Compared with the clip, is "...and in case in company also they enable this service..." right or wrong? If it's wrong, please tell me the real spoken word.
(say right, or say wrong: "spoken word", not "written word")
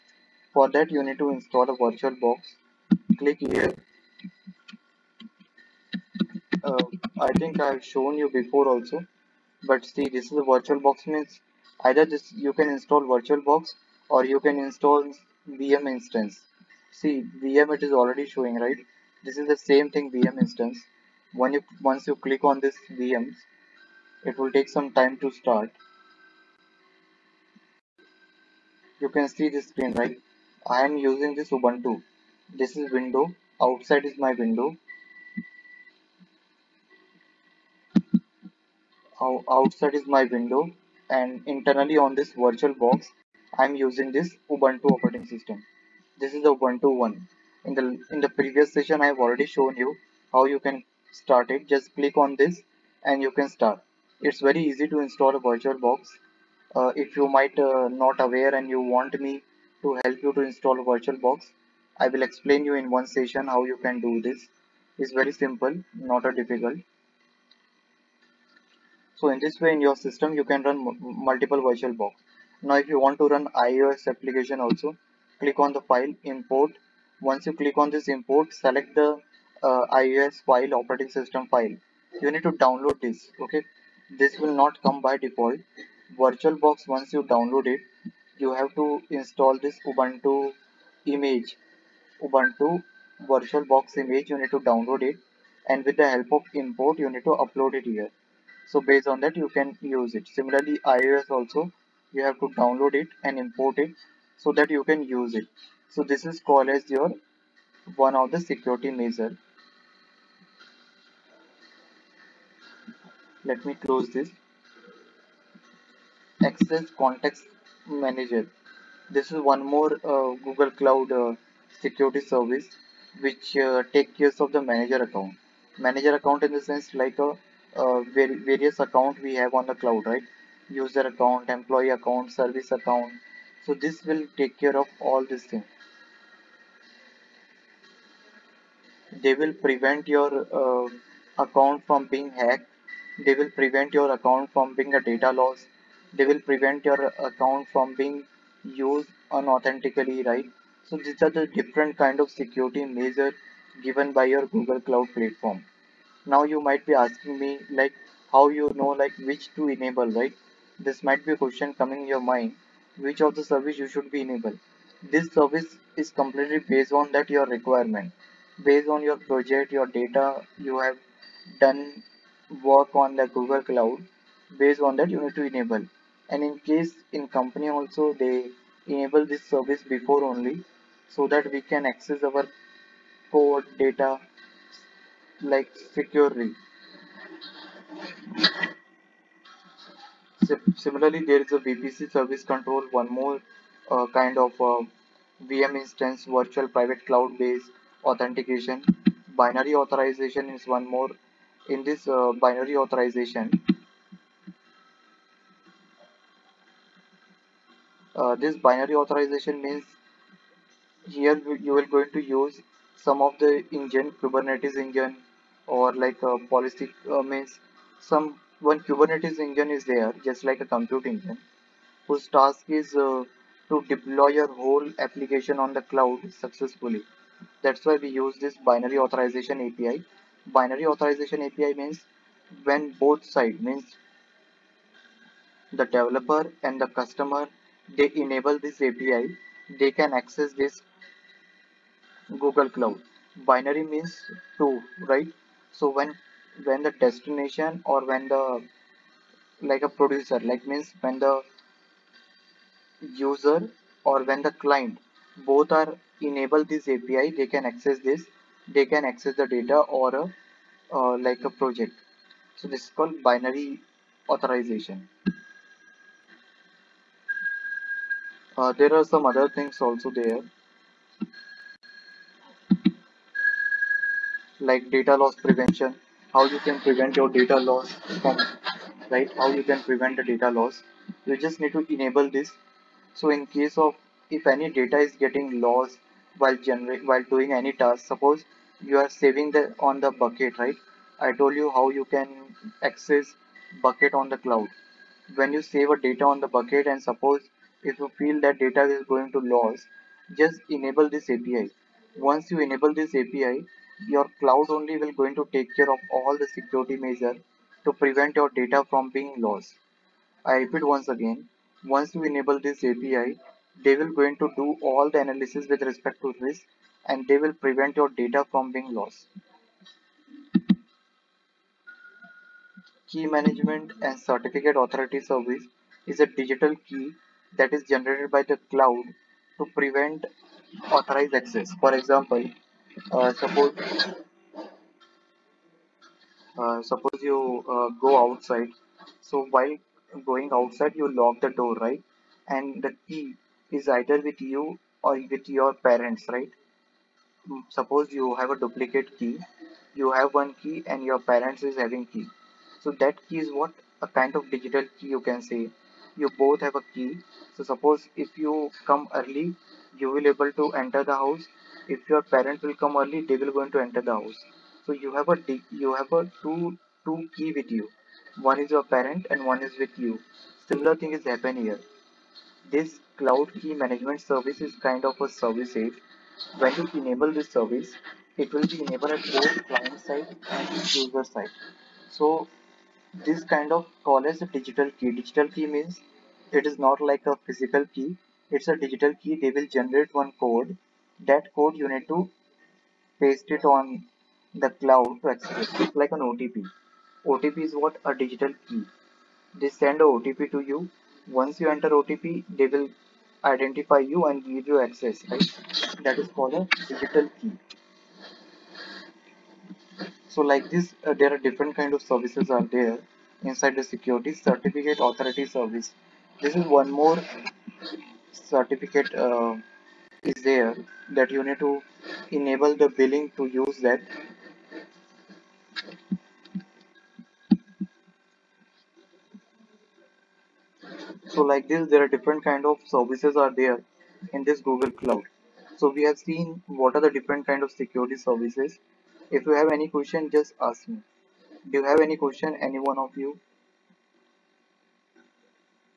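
right.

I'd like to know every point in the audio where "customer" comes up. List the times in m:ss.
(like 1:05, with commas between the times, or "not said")
3:56.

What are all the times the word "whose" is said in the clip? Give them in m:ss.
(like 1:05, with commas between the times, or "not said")
3:42.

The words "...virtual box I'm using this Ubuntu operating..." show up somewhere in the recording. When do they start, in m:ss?
0:42.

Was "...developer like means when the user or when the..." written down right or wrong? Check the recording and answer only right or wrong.
wrong.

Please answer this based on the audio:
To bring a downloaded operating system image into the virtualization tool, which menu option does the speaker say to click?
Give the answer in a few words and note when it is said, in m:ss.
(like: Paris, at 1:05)
file import, at 1:15.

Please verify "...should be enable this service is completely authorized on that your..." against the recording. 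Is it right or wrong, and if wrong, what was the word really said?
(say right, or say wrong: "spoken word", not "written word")
wrong: "based", not "authorized".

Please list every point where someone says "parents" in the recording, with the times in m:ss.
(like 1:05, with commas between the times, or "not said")
5:45, 5:51, 6:02, 6:08.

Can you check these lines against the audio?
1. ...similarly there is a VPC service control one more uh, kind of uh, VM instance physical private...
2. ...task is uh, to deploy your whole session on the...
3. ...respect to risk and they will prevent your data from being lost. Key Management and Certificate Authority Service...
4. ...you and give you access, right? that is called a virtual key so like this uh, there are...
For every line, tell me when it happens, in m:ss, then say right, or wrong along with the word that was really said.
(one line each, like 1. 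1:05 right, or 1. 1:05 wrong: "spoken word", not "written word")
1. 3:10 wrong: "virtual", not "physical"
2. 3:42 wrong: "application", not "session"
3. 5:15 right
4. 6:43 wrong: "digital", not "virtual".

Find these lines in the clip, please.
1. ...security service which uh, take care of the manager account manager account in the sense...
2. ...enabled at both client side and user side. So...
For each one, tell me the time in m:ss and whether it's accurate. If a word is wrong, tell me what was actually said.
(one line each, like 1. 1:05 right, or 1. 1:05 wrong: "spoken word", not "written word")
1. 2:01 right
2. 6:18 right.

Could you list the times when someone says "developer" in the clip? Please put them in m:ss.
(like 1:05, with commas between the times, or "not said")
3:55.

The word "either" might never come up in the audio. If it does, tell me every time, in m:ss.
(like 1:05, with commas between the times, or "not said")
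0:11, 5:43.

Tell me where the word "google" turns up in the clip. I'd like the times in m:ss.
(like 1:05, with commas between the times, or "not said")
2:00, 2:34, 2:53, 4:02, 7:14.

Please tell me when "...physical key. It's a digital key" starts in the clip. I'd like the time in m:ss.
6:27.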